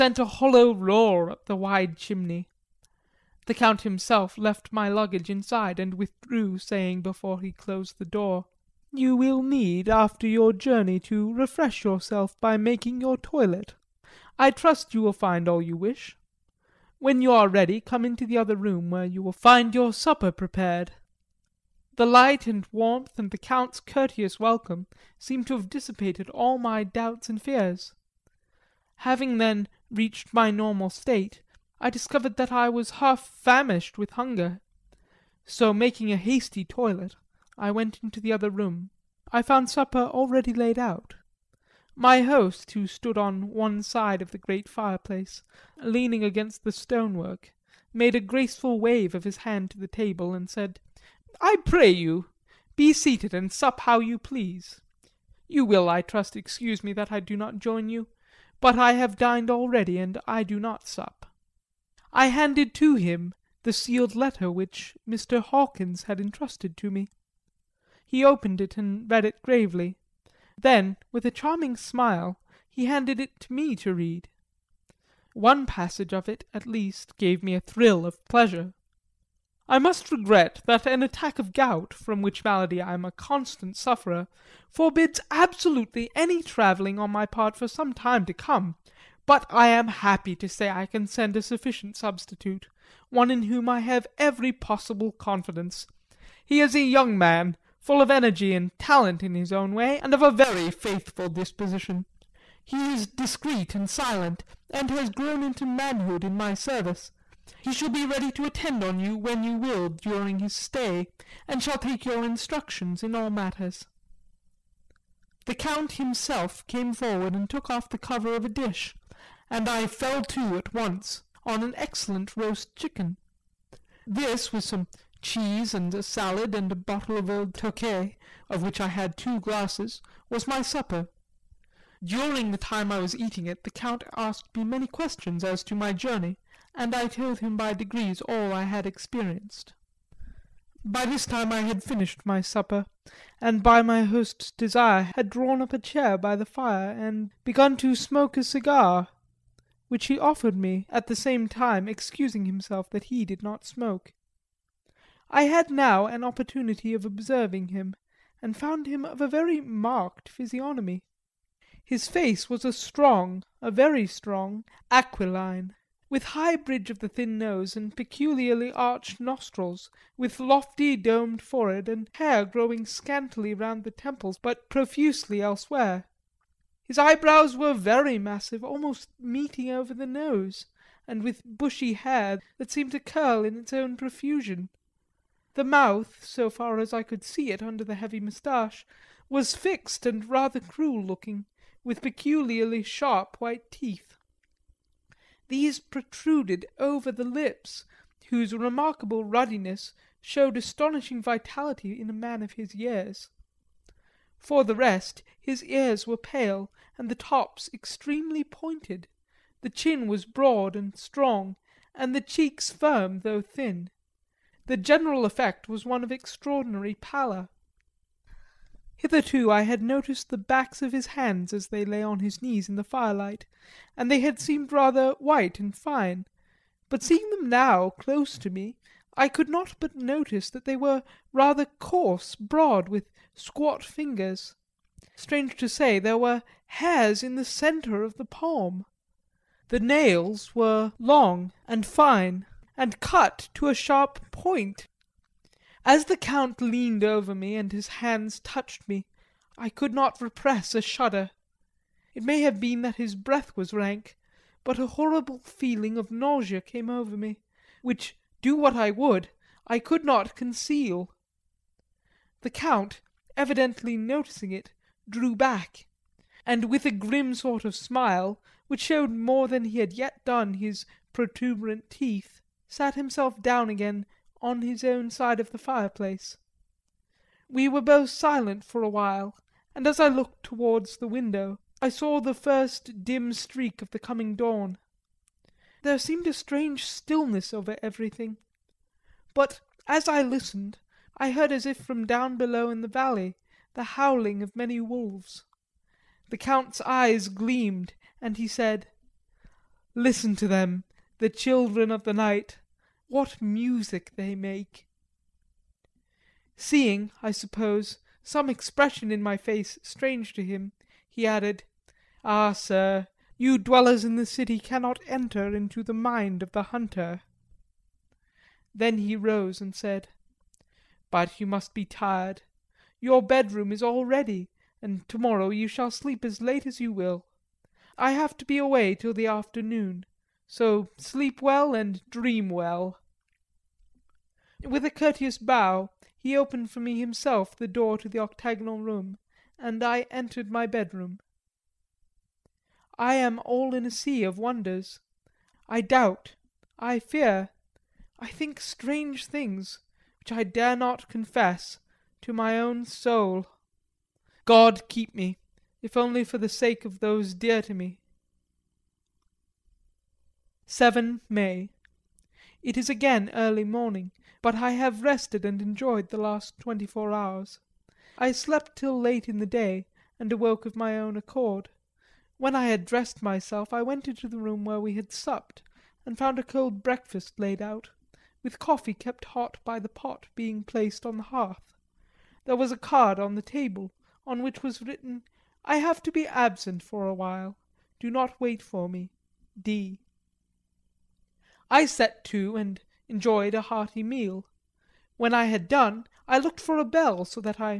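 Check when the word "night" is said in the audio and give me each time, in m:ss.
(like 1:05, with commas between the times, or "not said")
5:02.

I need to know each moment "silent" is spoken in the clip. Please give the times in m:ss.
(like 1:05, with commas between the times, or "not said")
1:43, 4:38.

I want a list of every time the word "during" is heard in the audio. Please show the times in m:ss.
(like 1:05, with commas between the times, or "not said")
1:49, 2:12.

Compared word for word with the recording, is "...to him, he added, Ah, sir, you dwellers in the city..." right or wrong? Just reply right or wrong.
right.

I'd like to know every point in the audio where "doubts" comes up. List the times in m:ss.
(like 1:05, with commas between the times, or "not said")
0:26, 5:45.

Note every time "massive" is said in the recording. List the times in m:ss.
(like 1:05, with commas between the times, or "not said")
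2:58.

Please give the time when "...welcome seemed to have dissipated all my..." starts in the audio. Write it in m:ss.
0:24.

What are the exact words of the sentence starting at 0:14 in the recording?
I trust you will find all you wish.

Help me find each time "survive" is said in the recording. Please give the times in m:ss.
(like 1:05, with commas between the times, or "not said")
not said.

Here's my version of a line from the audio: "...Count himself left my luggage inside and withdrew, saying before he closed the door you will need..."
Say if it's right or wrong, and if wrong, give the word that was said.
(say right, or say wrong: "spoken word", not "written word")
right.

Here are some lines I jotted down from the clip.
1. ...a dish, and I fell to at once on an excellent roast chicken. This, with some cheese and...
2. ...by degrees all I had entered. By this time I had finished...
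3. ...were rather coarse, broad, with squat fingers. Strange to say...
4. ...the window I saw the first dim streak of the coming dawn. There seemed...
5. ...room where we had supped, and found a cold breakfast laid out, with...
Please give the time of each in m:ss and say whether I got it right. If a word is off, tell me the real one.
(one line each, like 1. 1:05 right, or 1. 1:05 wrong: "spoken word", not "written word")
1. 1:58 right
2. 2:17 wrong: "experienced", not "entered"
3. 3:50 right
4. 4:40 right
5. 6:14 right.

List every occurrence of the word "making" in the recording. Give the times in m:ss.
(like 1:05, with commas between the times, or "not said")
0:12, 0:35.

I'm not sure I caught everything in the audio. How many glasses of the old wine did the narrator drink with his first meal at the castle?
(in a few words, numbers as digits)
2.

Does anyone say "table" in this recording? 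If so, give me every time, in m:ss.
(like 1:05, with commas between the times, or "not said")
0:49, 6:23.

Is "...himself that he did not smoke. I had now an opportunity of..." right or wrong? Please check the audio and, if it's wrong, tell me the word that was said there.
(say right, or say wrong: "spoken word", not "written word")
right.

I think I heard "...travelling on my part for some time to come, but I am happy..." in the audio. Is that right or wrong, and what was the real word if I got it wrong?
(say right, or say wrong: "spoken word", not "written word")
right.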